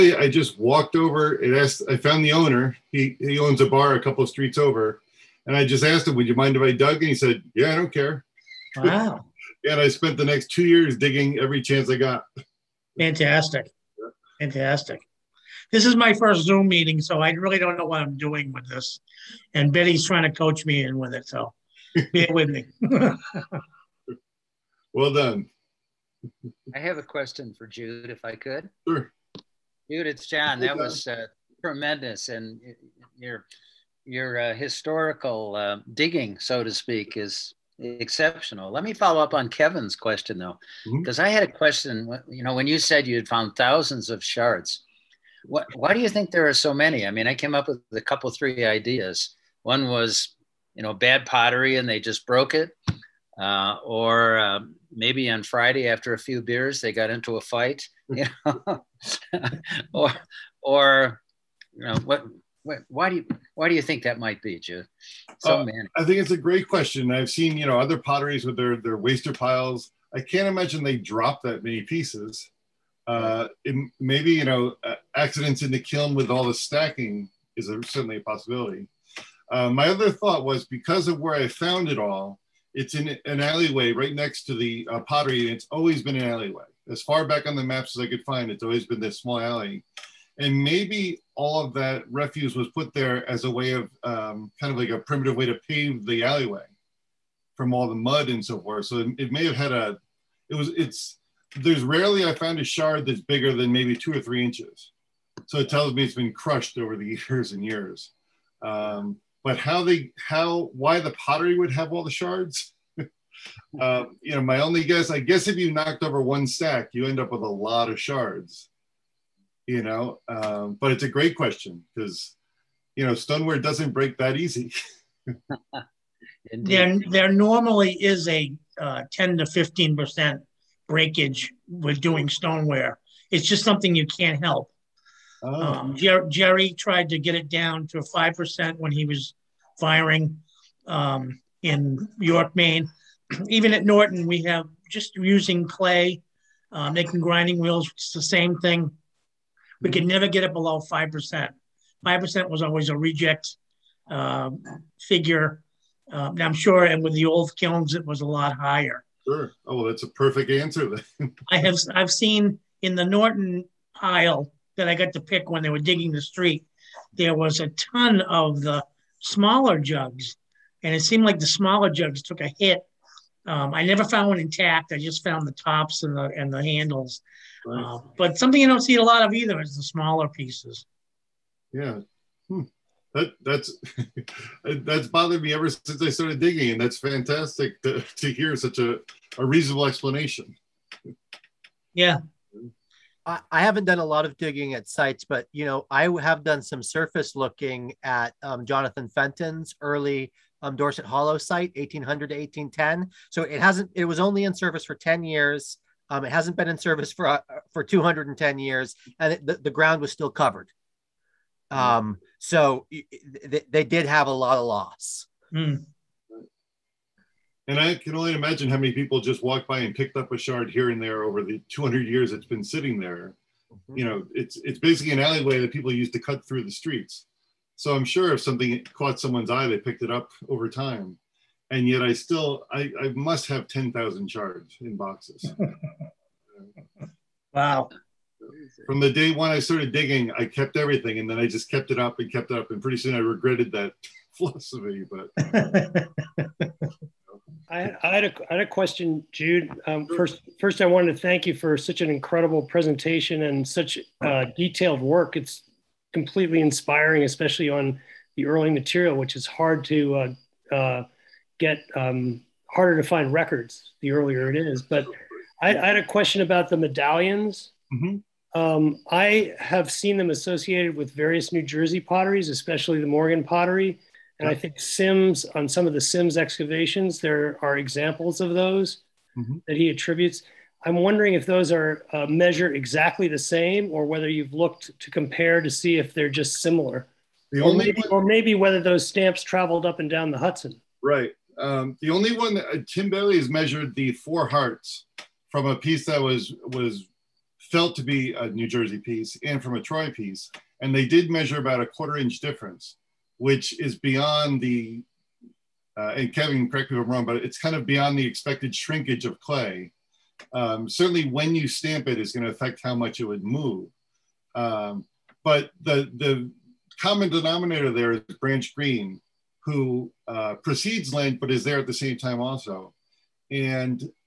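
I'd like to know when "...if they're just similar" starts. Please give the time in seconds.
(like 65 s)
285 s.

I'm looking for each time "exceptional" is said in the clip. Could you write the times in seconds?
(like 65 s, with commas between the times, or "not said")
37 s.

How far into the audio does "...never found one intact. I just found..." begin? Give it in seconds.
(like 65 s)
173 s.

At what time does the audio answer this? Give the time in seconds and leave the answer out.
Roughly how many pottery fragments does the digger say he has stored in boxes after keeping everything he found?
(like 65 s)
233 s.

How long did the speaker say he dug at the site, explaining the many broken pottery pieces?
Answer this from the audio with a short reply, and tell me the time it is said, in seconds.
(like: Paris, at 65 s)
2 years, at 10 s.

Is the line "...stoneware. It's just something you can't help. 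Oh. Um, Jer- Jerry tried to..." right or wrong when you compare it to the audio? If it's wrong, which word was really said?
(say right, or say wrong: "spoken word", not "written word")
right.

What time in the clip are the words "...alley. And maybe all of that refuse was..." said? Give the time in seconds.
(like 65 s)
89 s.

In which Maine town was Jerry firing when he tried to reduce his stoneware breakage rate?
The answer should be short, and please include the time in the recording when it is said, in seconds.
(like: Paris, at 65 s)
York, at 142 s.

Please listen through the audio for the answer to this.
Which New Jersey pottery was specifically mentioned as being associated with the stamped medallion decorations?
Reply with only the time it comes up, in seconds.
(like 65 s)
273 s.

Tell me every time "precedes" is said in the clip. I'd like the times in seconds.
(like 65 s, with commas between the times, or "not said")
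320 s.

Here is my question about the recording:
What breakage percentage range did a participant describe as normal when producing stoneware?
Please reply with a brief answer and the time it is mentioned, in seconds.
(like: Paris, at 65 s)
10 to 15 percent, at 129 s.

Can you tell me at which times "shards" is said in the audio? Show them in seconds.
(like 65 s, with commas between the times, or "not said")
44 s, 102 s, 112 s, 117 s, 220 s, 234 s.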